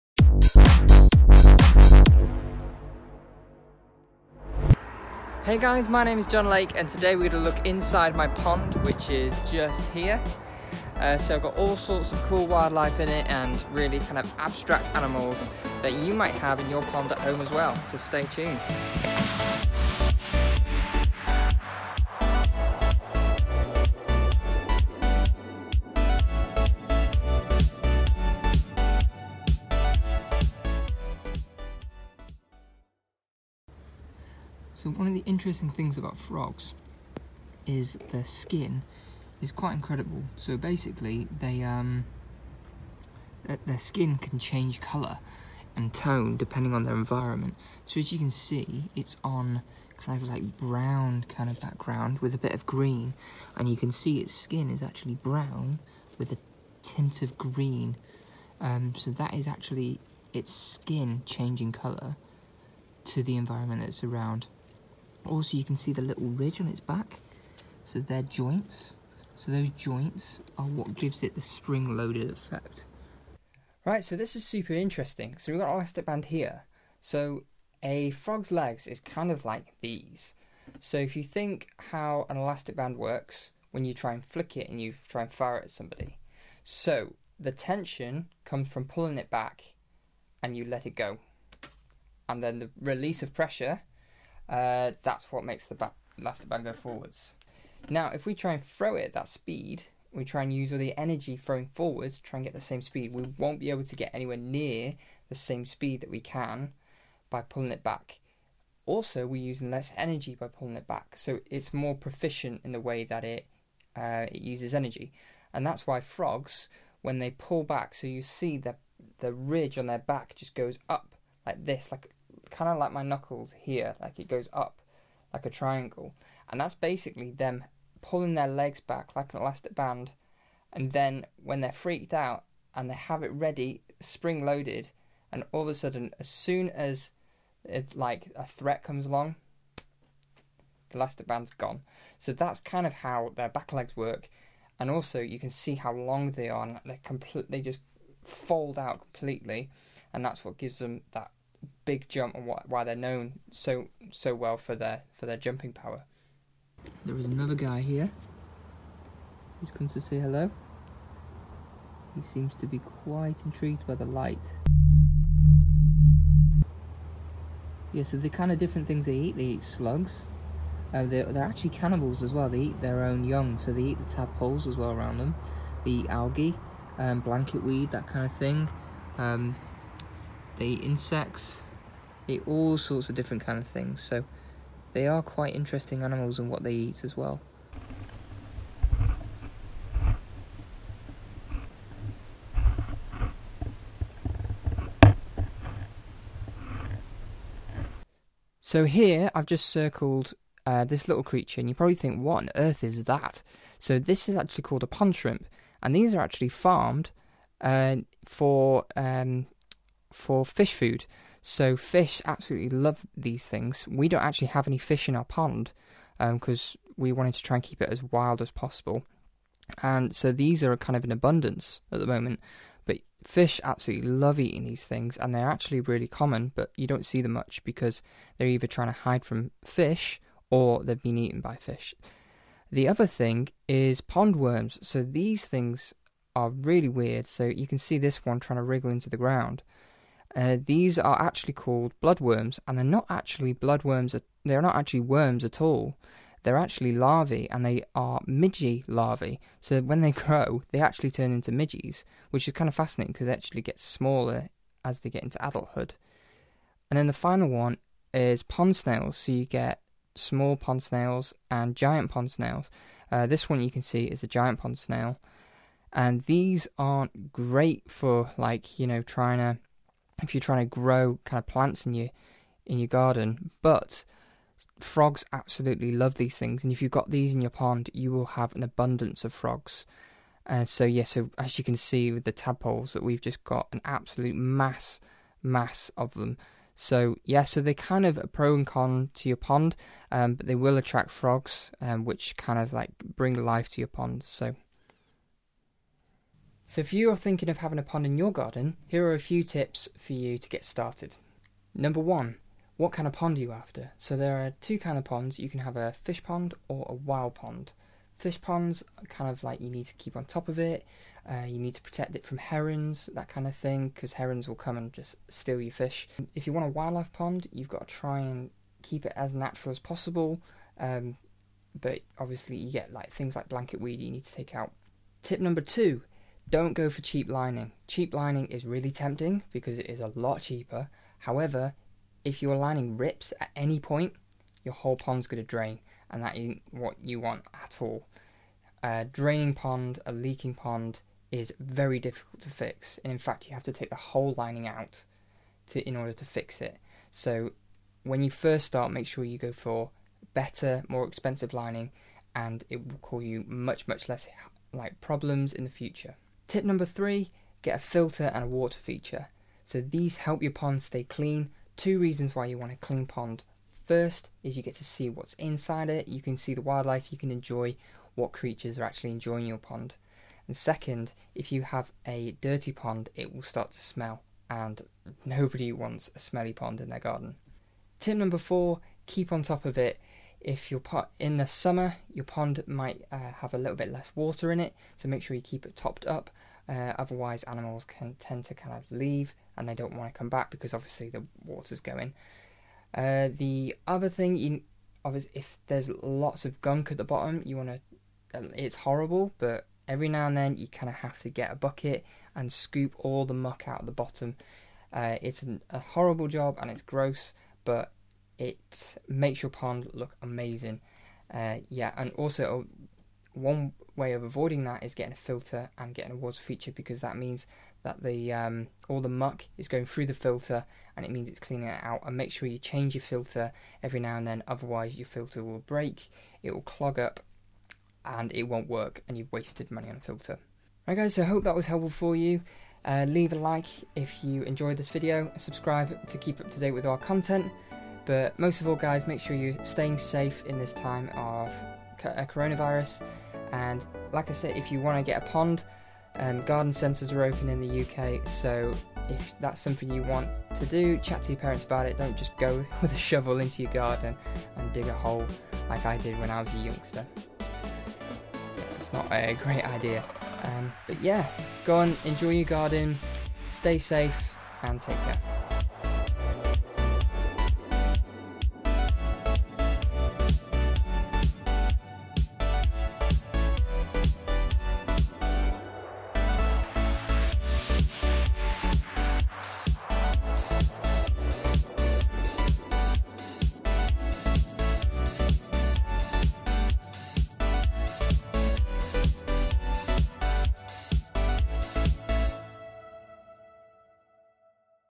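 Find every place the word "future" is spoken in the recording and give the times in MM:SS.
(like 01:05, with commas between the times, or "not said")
05:55.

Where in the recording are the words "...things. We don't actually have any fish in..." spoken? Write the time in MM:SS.
03:33.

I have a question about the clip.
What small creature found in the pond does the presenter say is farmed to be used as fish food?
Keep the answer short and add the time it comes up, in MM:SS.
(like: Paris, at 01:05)
Pond shrimp, at 03:24.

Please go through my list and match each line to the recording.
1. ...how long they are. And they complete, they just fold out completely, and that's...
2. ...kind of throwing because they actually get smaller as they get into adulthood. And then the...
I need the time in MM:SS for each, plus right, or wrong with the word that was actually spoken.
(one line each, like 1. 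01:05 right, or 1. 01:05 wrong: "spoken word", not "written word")
1. 02:25 right
2. 04:12 wrong: "fascinating", not "throwing".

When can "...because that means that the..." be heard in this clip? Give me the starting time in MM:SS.
06:56.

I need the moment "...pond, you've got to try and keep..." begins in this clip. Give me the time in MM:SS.
05:17.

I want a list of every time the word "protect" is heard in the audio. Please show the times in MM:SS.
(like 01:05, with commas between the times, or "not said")
05:11.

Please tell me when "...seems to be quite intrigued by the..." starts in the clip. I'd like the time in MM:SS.
02:42.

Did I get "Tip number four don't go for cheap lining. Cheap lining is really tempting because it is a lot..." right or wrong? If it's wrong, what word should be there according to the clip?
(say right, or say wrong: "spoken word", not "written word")
wrong: "two", not "four".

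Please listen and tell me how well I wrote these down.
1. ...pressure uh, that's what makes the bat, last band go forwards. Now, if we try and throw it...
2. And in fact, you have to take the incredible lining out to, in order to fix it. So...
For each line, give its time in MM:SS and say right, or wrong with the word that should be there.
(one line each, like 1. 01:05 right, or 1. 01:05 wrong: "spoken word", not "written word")
1. 01:33 right
2. 05:43 wrong: "whole", not "incredible".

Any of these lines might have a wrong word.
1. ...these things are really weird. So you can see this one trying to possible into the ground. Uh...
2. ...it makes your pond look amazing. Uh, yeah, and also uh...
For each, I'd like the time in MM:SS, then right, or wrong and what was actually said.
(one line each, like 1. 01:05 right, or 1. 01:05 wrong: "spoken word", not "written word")
1. 03:55 wrong: "wriggle", not "possible"
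2. 06:48 right.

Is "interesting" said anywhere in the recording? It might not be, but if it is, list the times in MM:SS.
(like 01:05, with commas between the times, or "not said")
00:35, 01:14, 03:05.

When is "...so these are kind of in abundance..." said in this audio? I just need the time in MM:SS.
03:40.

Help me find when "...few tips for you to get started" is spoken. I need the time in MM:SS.
04:59.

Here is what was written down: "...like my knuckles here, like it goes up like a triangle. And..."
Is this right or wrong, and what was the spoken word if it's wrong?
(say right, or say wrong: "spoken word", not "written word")
right.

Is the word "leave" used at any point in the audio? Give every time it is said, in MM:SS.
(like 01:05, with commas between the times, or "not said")
06:28, 07:13.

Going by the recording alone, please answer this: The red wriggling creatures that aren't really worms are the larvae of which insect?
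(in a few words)
Midges.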